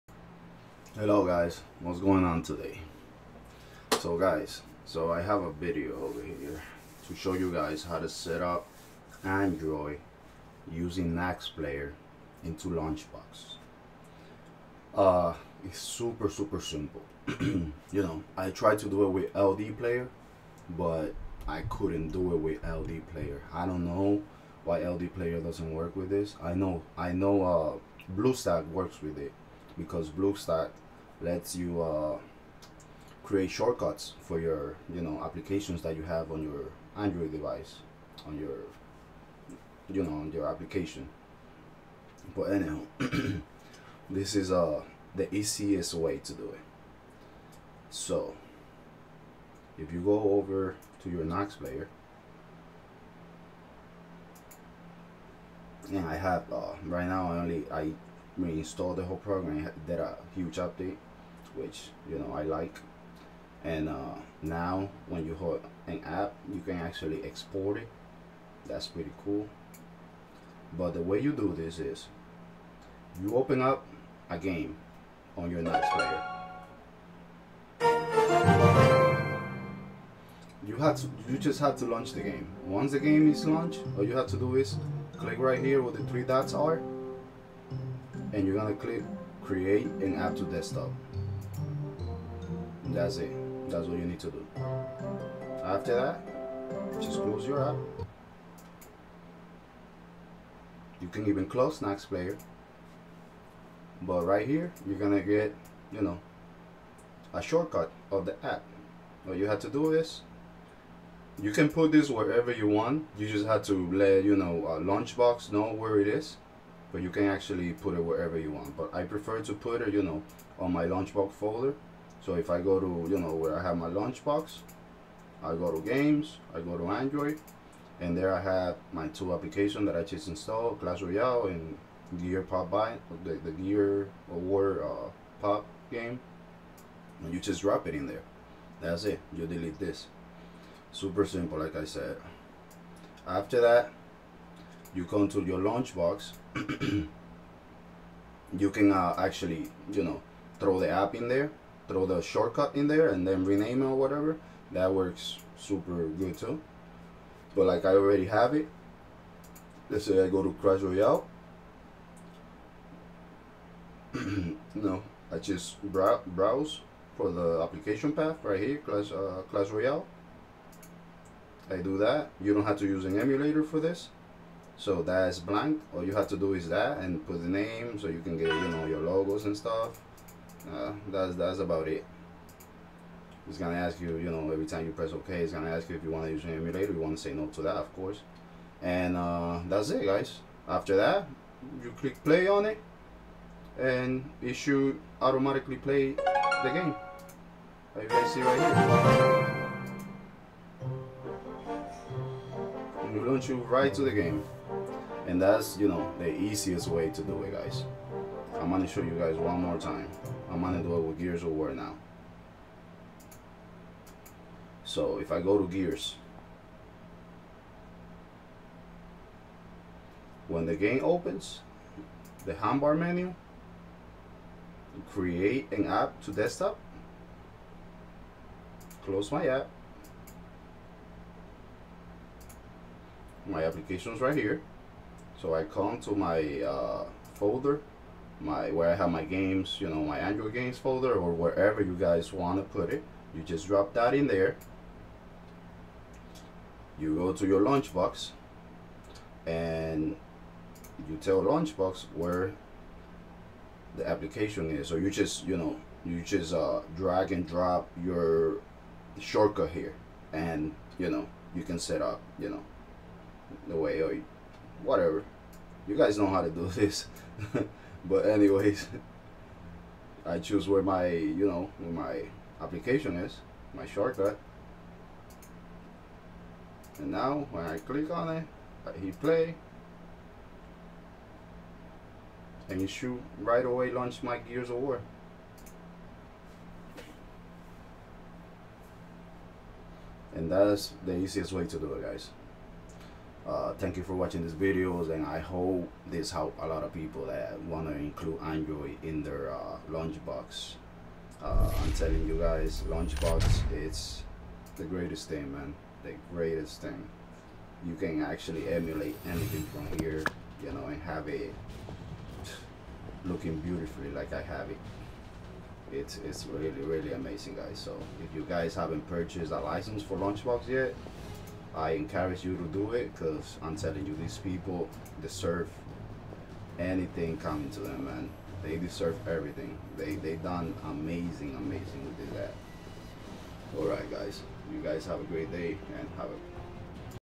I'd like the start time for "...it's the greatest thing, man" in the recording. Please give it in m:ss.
5:03.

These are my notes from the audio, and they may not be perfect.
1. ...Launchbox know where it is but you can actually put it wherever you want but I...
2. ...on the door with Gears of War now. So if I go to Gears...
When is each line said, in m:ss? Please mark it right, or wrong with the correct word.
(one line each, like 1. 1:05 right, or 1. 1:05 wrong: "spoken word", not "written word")
1. 1:55 right
2. 3:30 right.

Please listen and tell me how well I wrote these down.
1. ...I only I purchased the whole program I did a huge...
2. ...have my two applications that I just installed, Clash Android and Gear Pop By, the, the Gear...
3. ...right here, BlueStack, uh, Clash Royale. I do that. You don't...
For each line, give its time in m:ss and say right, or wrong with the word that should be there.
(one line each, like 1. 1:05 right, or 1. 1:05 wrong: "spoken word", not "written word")
1. 0:57 wrong: "reinstalled", not "purchased"
2. 2:08 wrong: "Royale", not "Android"
3. 2:48 wrong: "Clash", not "BlueStack".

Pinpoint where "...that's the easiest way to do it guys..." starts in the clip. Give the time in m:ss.
4:50.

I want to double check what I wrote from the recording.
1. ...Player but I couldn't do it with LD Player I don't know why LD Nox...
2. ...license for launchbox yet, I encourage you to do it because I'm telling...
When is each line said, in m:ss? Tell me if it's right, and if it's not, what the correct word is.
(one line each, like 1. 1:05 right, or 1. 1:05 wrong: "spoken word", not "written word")
1. 0:19 wrong: "Player", not "Nox"
2. 5:19 right.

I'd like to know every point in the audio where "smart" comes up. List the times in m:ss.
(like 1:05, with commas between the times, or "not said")
not said.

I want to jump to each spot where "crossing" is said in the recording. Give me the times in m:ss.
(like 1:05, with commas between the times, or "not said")
not said.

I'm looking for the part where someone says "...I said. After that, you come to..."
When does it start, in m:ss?
2:21.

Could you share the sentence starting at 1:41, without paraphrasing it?
You can even close Nox Player.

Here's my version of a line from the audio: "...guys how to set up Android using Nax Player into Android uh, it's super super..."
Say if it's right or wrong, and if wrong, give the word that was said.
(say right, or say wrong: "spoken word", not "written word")
wrong: "Launchbox", not "Android".